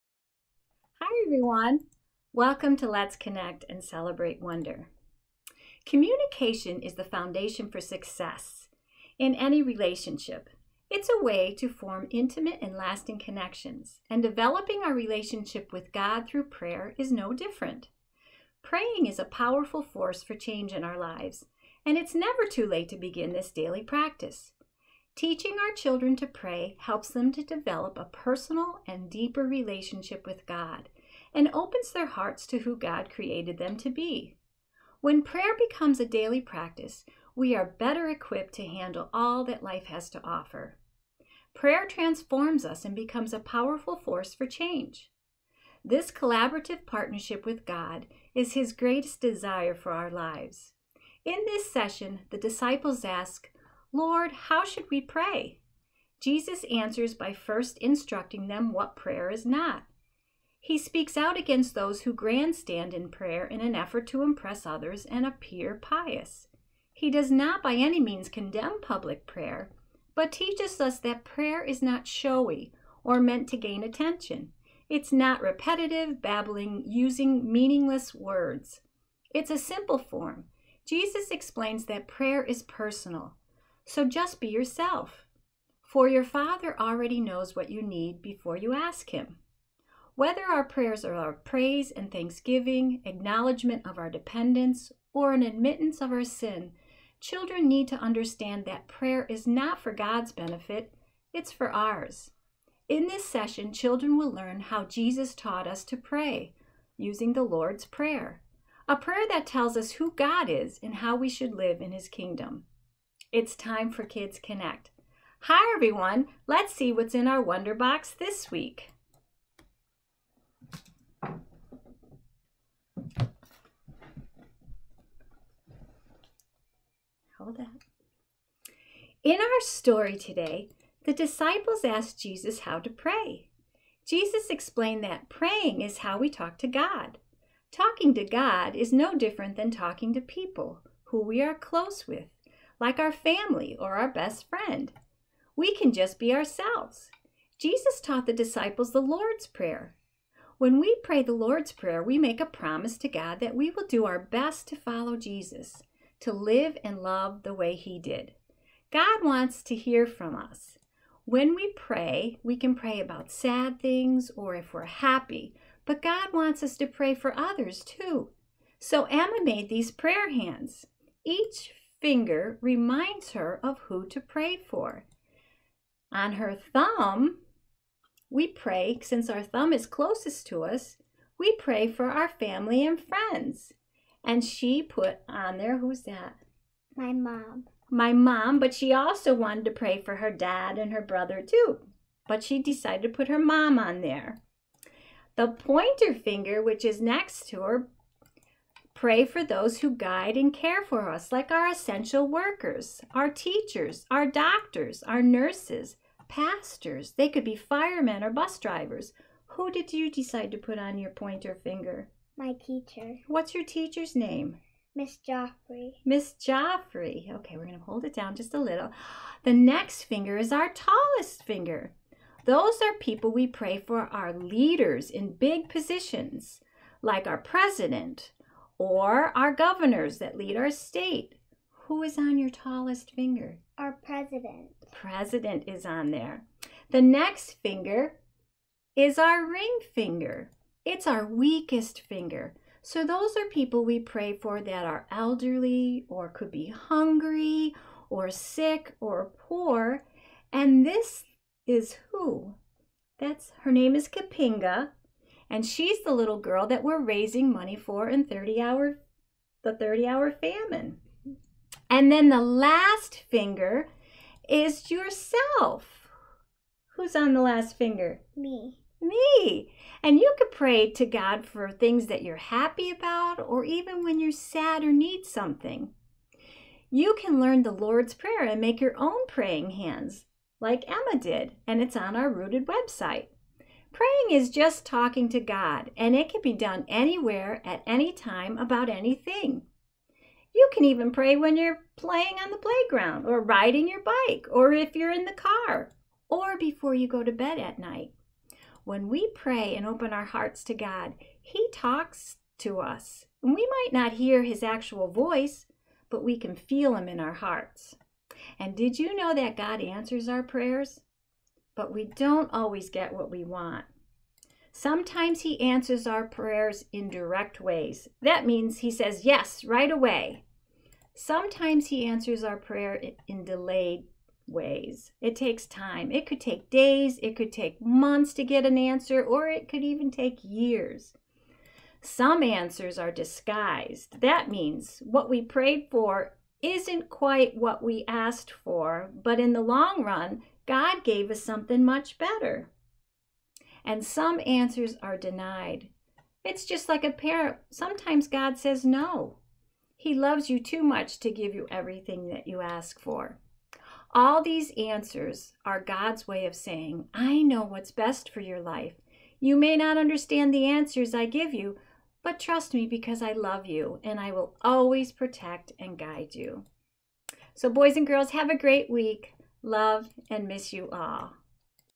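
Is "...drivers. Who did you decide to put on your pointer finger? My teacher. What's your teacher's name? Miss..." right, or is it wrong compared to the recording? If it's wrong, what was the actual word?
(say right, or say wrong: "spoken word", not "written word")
right.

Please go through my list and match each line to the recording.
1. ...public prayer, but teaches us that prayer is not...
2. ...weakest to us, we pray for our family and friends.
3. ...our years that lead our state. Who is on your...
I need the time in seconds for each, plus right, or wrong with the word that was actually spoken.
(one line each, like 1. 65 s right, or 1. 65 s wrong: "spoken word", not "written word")
1. 68 s right
2. 179 s wrong: "closest", not "weakest"
3. 229 s wrong: "governors", not "years".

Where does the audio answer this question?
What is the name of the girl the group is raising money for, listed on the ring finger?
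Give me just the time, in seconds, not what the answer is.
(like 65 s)
254 s.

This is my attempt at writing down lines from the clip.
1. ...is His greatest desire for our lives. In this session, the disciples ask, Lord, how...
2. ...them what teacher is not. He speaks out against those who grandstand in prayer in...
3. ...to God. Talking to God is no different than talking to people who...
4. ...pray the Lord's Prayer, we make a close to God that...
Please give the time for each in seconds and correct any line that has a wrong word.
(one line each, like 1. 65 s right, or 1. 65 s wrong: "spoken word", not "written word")
1. 48 s right
2. 58 s wrong: "prayer", not "teacher"
3. 136 s right
4. 151 s wrong: "promise", not "close".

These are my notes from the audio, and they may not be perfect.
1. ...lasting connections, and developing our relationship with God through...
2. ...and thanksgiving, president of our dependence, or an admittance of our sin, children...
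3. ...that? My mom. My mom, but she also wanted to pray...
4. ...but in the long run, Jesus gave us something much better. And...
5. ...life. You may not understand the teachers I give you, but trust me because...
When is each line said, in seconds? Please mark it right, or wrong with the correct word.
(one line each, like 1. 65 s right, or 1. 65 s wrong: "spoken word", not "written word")
1. 12 s right
2. 91 s wrong: "acknowledgement", not "president"
3. 186 s right
4. 339 s wrong: "God", not "Jesus"
5. 358 s wrong: "answers", not "teachers".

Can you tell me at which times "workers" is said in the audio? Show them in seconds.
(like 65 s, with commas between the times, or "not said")
202 s.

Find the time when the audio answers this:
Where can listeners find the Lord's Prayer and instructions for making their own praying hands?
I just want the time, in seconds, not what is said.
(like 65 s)
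282 s.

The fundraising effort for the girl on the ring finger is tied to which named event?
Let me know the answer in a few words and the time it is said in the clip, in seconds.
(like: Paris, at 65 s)
30 Hour Famine, at 259 s.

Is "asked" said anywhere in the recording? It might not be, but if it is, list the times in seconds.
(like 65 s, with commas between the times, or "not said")
131 s, 338 s.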